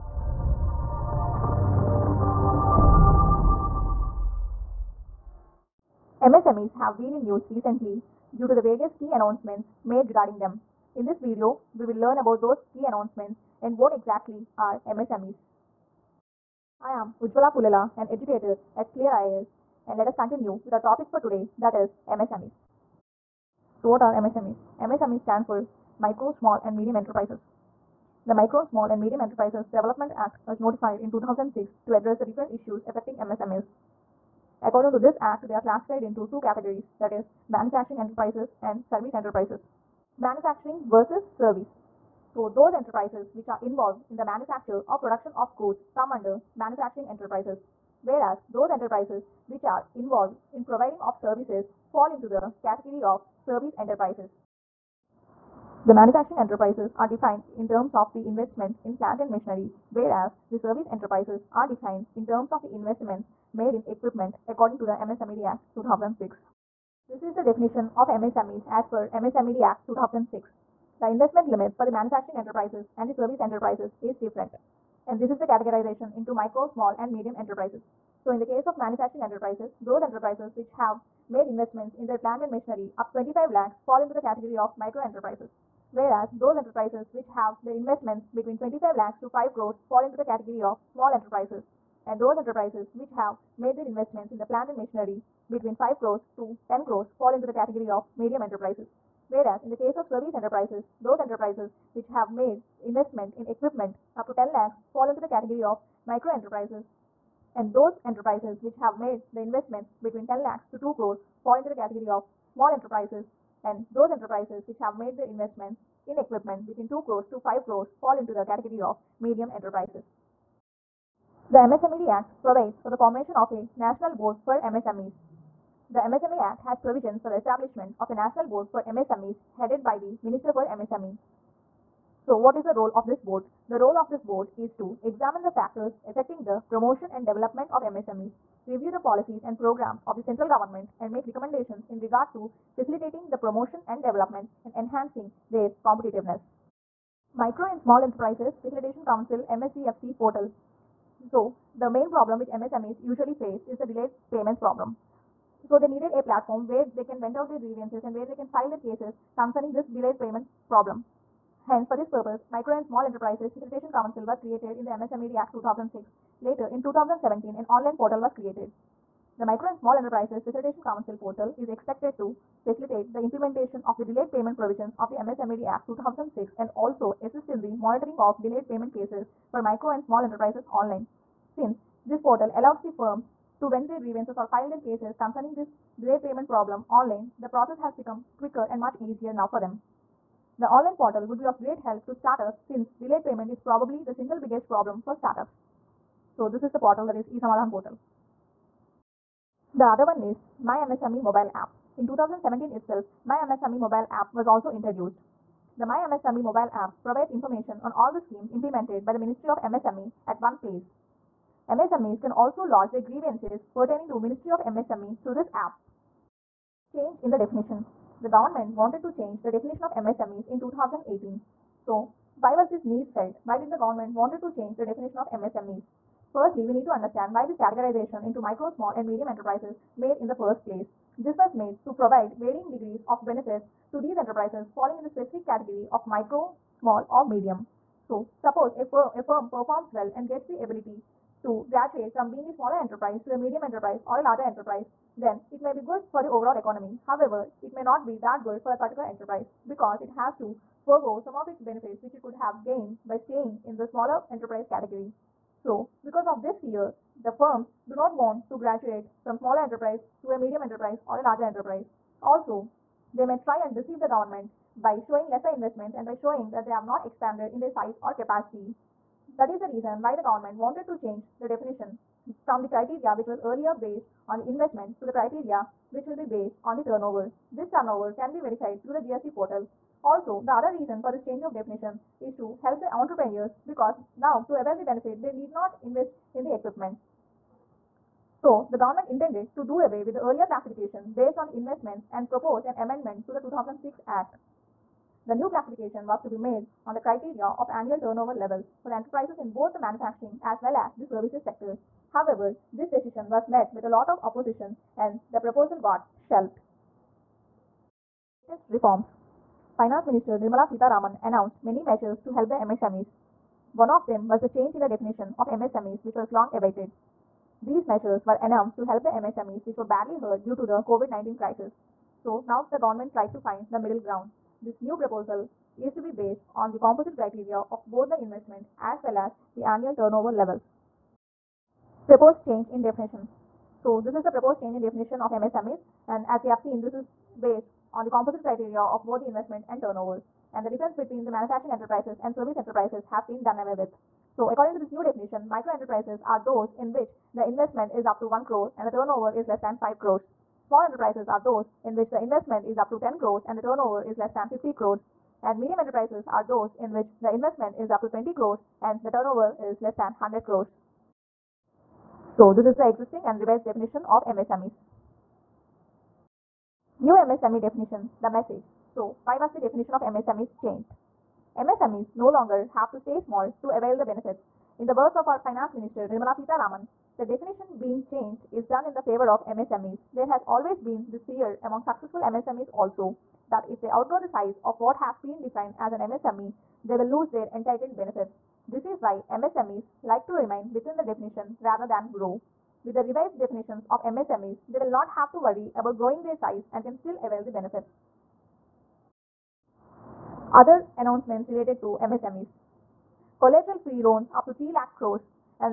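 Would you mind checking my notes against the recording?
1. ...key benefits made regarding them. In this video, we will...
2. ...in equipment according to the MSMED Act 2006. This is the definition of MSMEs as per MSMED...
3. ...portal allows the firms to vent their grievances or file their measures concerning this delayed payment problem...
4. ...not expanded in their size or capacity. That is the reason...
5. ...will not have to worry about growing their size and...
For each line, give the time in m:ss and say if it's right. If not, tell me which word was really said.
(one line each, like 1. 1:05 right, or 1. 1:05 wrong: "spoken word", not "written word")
1. 0:08 wrong: "announcements", not "benefits"
2. 1:03 right
3. 3:02 wrong: "cases", not "measures"
4. 4:26 right
5. 6:34 right.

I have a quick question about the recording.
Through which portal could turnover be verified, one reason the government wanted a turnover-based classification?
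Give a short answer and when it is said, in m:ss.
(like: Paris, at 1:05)
GST portal, at 4:39.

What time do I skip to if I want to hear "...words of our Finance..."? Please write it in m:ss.
6:14.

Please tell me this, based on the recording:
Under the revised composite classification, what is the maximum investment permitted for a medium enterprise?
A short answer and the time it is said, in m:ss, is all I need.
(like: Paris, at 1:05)
20 crores, at 5:58.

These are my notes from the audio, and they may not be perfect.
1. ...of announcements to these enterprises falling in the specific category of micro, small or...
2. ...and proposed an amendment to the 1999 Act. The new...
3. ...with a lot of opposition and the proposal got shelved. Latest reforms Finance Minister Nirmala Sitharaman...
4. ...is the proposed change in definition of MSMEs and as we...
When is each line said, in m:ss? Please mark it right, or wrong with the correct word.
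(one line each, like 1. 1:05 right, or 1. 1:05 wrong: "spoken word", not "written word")
1. 3:53 wrong: "benefits", not "announcements"
2. 4:52 wrong: "2006", not "1999"
3. 5:03 right
4. 5:34 right.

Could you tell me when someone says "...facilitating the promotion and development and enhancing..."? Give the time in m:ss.
2:22.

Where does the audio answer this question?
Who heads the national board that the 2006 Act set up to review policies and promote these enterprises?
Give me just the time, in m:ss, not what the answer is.
2:10.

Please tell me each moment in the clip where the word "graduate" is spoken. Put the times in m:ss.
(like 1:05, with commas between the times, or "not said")
4:01, 4:18.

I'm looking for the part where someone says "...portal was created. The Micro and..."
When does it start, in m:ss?
2:47.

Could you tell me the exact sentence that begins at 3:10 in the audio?
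The online portal would be of great help to startups since delayed payment is probably the single biggest problem for startups.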